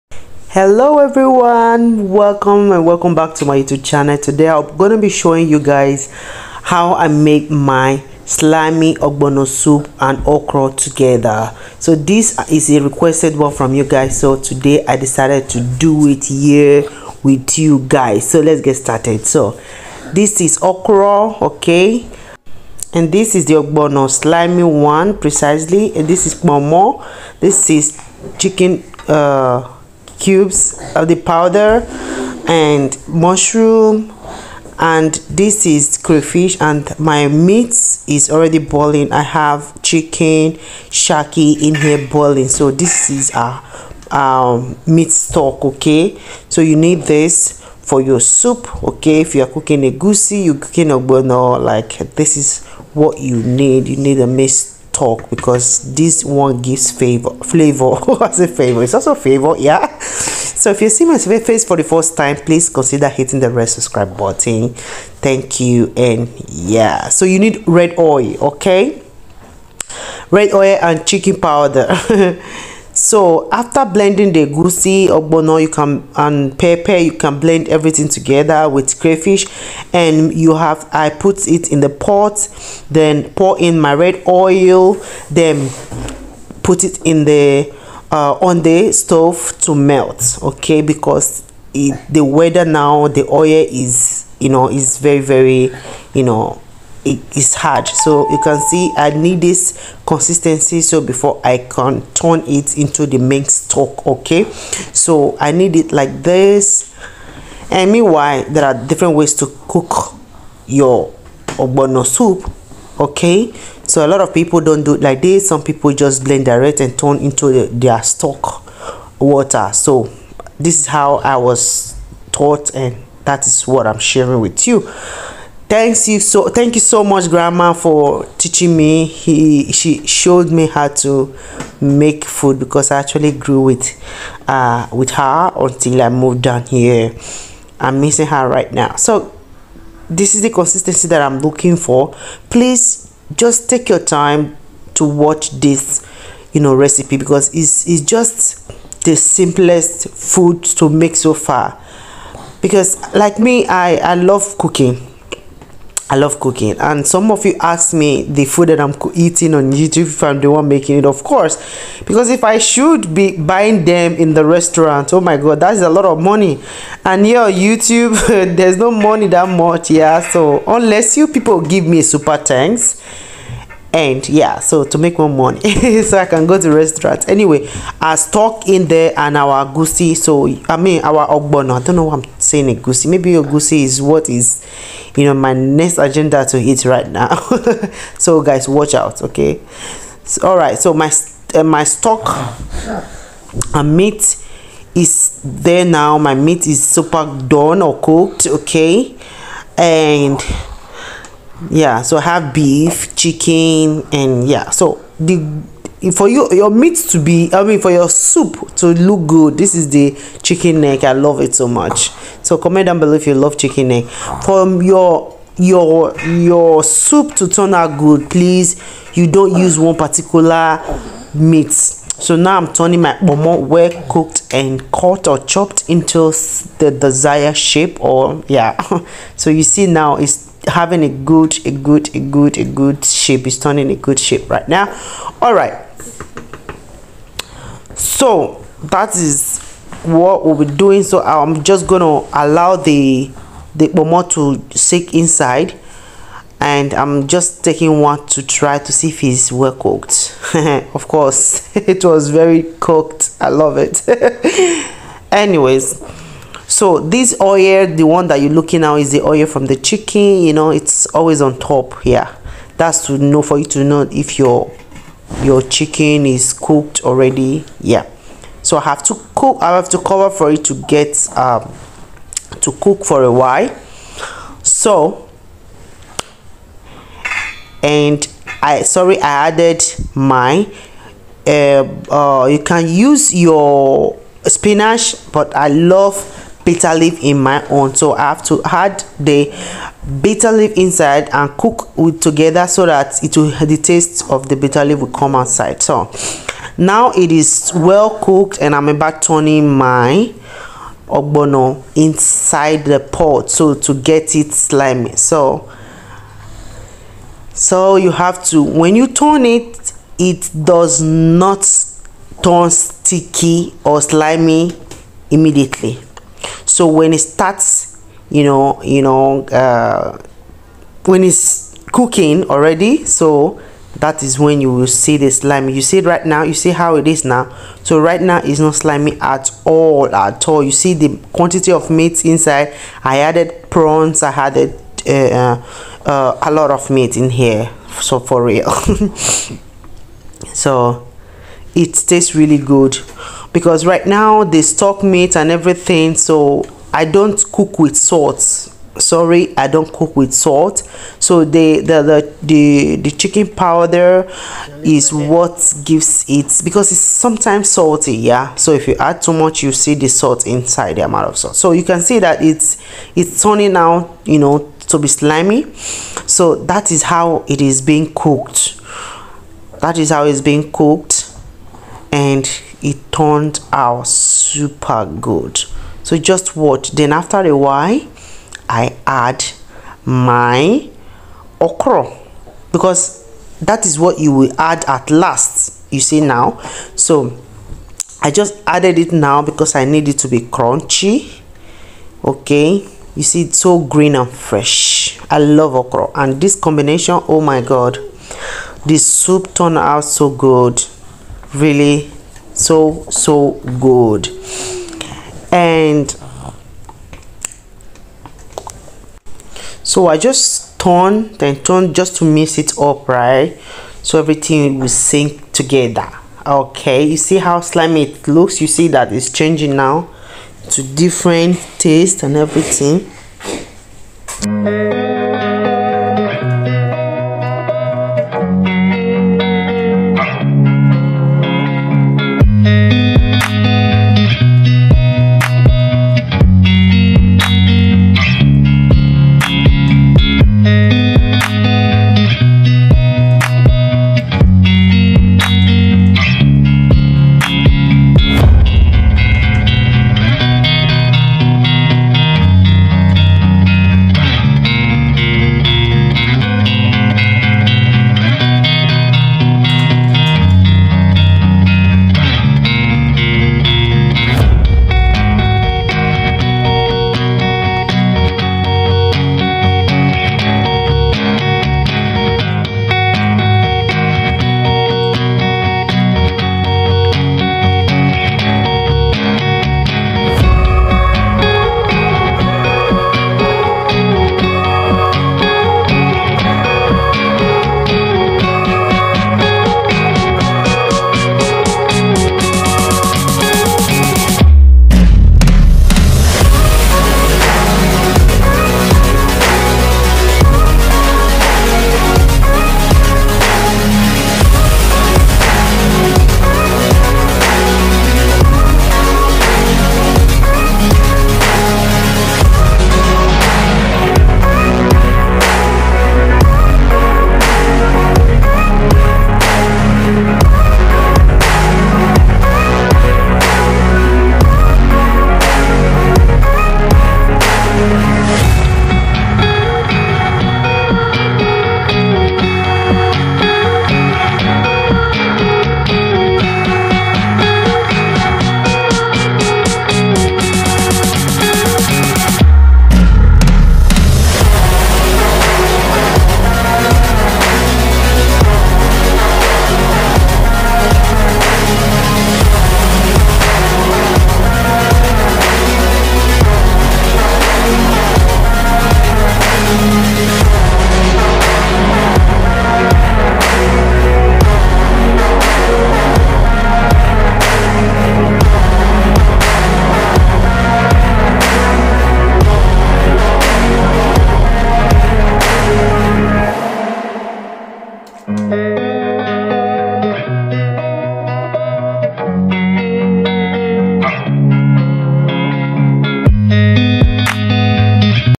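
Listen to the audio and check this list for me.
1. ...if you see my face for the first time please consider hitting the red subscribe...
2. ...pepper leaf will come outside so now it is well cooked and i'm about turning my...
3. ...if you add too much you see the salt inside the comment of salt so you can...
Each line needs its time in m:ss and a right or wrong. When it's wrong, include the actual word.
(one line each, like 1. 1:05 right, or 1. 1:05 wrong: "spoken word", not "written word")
1. 1:00 right
2. 4:54 wrong: "bitter", not "pepper"
3. 5:58 wrong: "amount", not "comment".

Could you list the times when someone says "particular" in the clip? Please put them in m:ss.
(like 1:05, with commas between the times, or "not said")
3:39.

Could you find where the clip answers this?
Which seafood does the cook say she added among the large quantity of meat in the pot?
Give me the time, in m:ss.
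5:33.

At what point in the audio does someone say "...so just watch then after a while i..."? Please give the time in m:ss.
6:16.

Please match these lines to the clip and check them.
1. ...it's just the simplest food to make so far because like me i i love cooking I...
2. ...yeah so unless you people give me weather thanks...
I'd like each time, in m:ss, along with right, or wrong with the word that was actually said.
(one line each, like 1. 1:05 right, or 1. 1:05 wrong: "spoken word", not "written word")
1. 2:27 right
2. 2:49 wrong: "super", not "weather".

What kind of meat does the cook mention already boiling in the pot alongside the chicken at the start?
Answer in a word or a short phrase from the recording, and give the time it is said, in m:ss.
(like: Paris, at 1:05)
shaki, at 0:40.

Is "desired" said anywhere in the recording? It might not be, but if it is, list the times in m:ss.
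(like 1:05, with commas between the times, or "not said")
3:46.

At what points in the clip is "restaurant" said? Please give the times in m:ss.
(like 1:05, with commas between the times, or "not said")
2:44, 2:56.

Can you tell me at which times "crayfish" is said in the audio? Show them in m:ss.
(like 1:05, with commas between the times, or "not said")
0:35, 1:18.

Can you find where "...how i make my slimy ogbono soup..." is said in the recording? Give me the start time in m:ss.
0:06.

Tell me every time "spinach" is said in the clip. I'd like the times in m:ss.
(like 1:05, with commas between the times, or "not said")
4:44.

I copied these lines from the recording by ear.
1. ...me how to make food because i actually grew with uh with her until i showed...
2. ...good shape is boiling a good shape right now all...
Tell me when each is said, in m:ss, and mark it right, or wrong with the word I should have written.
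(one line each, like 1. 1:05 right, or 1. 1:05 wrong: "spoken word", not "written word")
1. 2:10 wrong: "moved", not "showed"
2. 3:52 wrong: "turning", not "boiling".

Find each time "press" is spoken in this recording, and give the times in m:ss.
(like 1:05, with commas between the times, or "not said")
not said.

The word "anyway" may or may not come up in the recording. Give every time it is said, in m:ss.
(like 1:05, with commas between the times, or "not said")
2:57, 4:15.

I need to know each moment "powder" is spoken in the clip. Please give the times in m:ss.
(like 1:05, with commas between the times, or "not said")
0:31, 1:11, 5:53.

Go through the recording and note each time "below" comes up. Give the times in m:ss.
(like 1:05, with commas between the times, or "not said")
3:32.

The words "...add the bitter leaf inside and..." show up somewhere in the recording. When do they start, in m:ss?
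4:48.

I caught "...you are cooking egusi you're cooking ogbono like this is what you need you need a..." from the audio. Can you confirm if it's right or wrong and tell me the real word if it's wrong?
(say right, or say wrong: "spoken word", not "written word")
right.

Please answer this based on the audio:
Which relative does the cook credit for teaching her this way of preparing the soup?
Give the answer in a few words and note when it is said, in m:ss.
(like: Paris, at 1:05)
grandma, at 2:07.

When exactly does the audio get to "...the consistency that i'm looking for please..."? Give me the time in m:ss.
2:20.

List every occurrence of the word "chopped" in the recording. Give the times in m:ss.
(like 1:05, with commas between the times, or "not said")
3:45.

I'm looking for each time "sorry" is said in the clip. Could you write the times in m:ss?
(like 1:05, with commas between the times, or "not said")
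4:38, 5:48.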